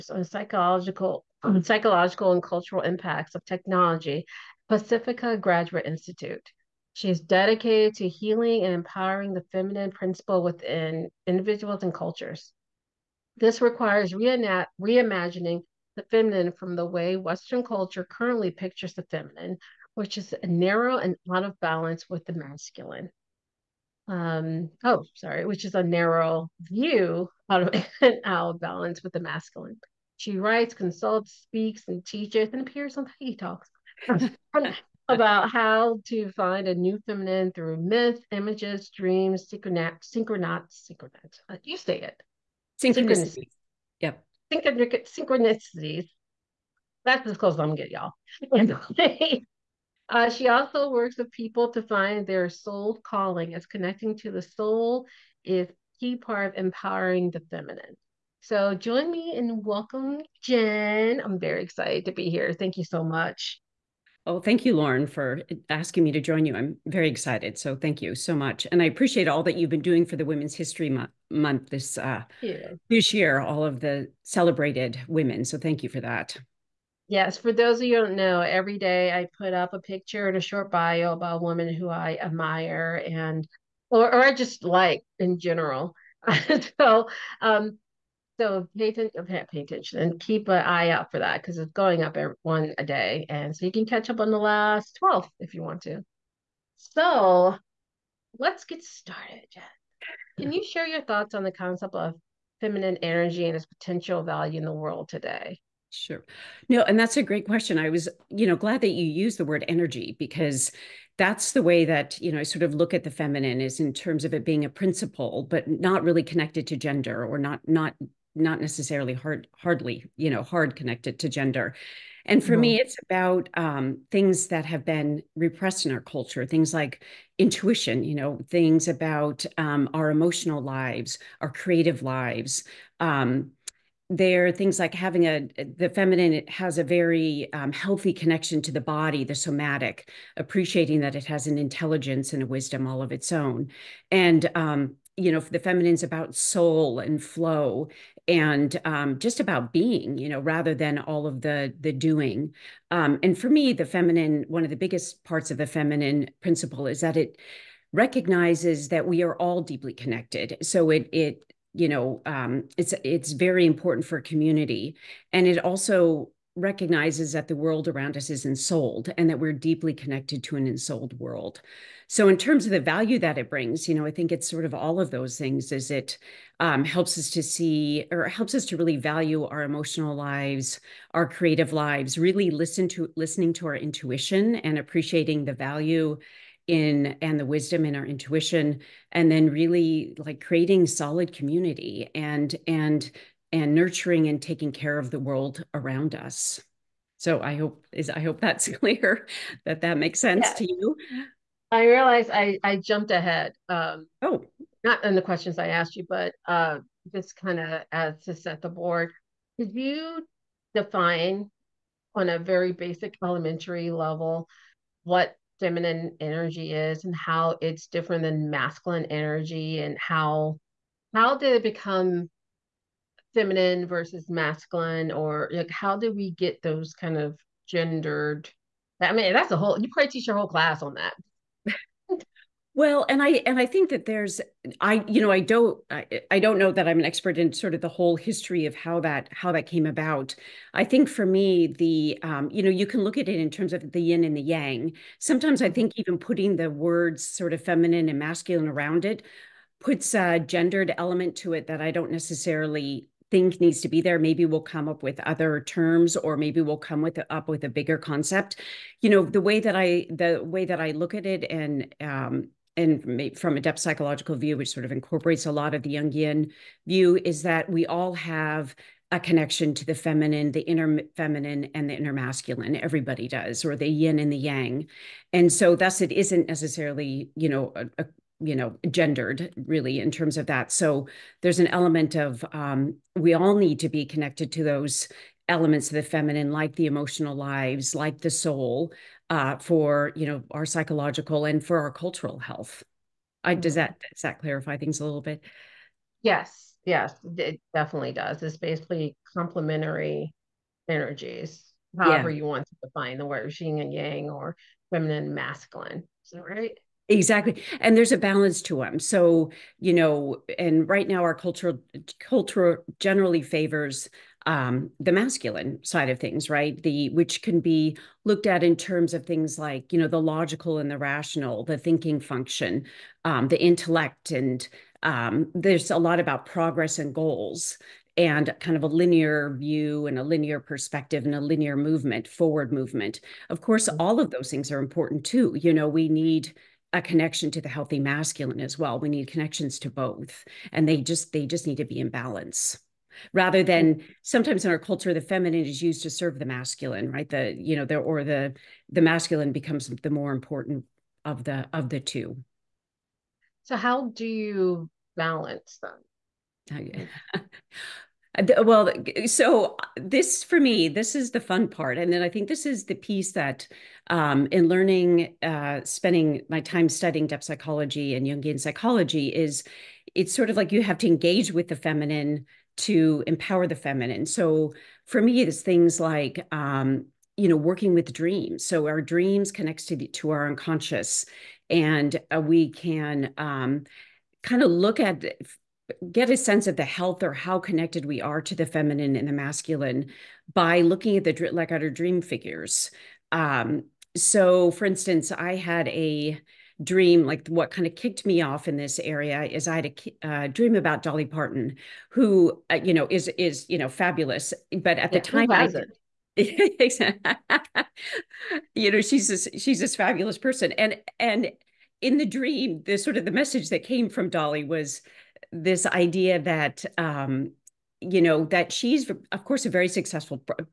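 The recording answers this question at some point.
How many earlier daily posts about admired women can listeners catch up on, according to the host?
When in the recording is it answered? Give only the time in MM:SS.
01:34.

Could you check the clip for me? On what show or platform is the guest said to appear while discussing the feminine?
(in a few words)
Peggy Talks.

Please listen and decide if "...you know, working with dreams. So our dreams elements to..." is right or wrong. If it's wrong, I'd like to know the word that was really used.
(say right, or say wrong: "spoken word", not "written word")
wrong: "connects", not "elements".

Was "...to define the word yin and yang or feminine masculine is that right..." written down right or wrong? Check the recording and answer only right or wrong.
right.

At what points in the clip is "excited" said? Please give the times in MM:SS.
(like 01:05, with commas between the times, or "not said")
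01:01, 01:07.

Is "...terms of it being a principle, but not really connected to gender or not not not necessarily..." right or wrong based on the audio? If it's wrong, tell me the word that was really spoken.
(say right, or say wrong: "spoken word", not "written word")
right.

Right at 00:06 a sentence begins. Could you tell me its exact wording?
She is dedicated to healing and empowering the feminine principle within individuals and cultures.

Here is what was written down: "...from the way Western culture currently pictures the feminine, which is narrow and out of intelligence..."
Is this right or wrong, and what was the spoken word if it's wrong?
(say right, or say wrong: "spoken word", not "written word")
wrong: "balance", not "intelligence".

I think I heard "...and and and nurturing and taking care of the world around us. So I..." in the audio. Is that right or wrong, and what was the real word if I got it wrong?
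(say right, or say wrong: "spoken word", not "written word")
right.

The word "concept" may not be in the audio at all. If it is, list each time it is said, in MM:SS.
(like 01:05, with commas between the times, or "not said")
01:41, 04:17.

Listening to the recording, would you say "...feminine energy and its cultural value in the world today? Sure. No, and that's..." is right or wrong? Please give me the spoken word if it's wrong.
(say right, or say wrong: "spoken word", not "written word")
wrong: "potential", not "cultural".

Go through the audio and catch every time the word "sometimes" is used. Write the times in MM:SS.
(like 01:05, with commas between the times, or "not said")
04:05, 05:44.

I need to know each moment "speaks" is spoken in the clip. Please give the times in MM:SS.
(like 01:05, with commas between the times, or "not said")
00:31.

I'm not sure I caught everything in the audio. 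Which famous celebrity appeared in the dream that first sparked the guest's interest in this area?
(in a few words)
Dolly Parton.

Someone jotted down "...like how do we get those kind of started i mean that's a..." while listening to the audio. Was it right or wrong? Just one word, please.
wrong.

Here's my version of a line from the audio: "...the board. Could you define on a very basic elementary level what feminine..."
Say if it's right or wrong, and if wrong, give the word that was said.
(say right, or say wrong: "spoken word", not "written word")
right.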